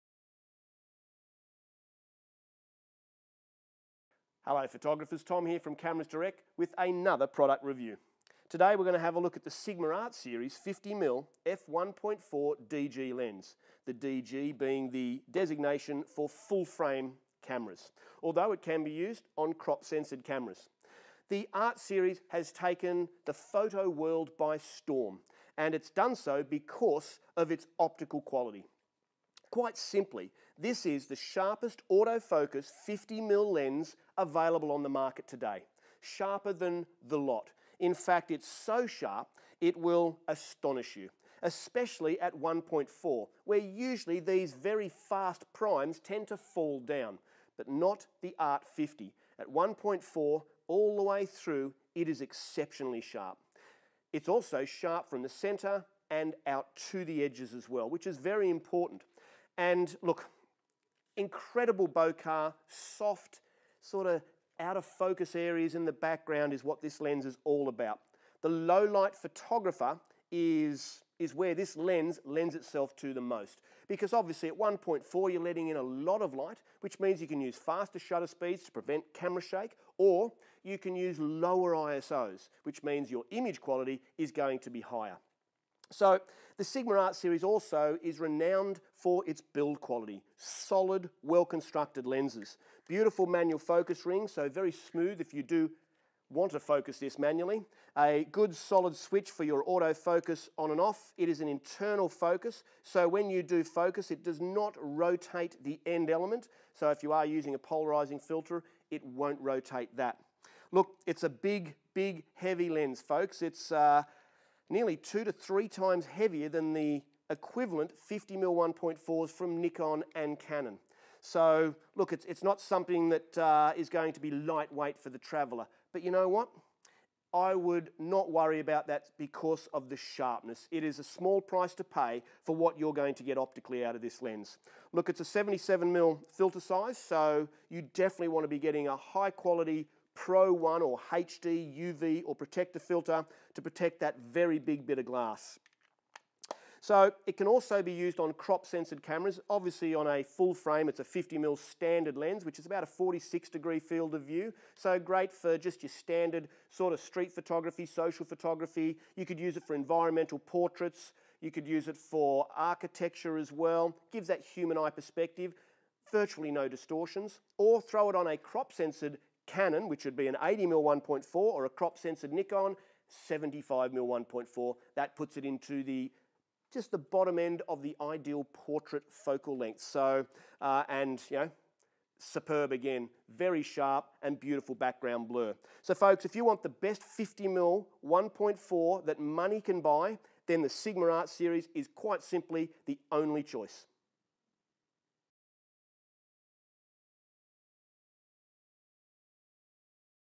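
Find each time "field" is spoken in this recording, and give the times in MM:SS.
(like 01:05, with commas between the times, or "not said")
02:33.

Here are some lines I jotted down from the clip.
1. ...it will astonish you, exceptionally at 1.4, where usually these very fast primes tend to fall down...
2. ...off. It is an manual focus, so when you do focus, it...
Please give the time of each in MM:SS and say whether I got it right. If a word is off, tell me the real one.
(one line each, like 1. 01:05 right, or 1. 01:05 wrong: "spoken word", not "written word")
1. 00:39 wrong: "especially", not "exceptionally"
2. 01:40 wrong: "internal", not "manual".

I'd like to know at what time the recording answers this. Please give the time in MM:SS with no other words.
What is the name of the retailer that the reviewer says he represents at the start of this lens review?
00:05.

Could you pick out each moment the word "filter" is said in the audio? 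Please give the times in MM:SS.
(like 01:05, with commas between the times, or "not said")
01:48, 02:16, 02:22.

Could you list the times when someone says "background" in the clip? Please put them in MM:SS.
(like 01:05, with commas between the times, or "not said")
01:05, 03:04.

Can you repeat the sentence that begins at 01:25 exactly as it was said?
So the Sigma Art series also is renowned for its build quality.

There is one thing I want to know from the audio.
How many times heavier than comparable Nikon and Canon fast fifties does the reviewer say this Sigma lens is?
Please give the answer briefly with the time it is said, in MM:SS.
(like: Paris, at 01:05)
2 to 3 times, at 01:54.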